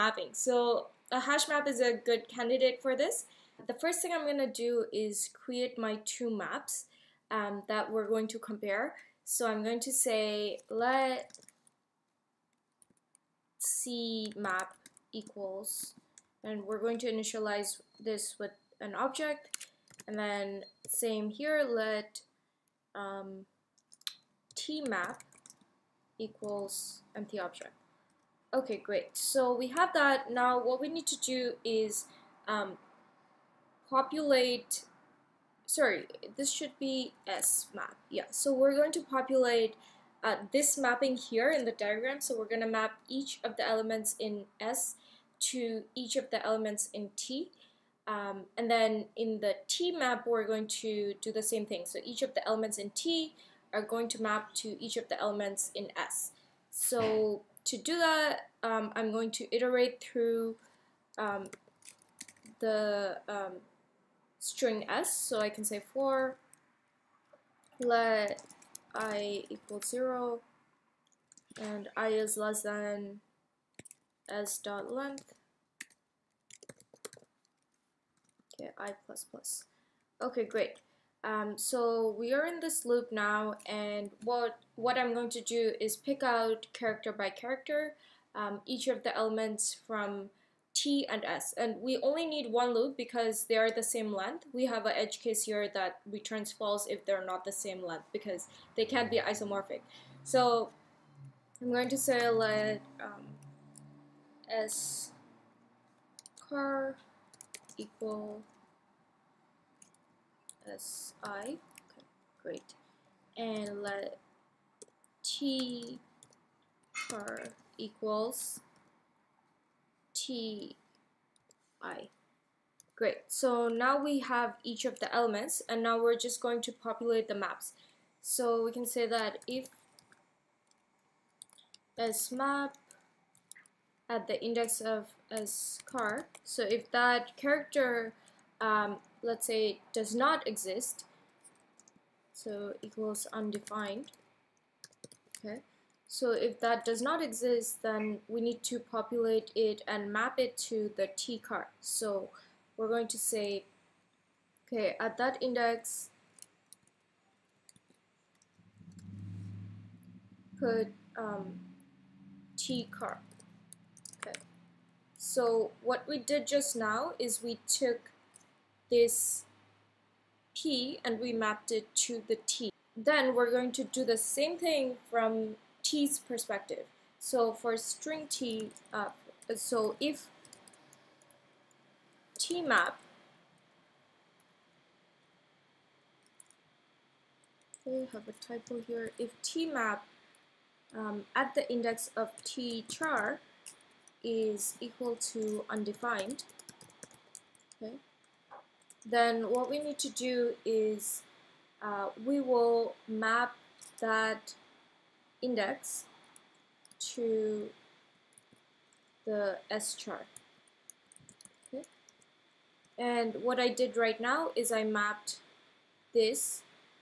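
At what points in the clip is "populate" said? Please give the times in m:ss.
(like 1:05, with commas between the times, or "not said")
0:33, 0:39, 2:06, 2:28.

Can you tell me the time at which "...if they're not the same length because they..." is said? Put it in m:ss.
1:36.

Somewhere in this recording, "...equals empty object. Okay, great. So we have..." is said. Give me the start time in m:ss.
0:26.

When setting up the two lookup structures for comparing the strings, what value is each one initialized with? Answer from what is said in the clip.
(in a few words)
an object.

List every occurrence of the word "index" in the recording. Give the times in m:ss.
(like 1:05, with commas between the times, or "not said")
2:14, 2:35, 3:11, 3:25.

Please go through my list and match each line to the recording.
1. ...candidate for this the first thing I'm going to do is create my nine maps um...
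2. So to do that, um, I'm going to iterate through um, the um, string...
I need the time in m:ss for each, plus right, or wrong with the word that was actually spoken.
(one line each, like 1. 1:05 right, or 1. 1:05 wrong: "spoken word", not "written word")
1. 0:02 wrong: "two", not "nine"
2. 0:56 right.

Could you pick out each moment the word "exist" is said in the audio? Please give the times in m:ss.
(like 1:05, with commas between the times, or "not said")
2:20, 2:27.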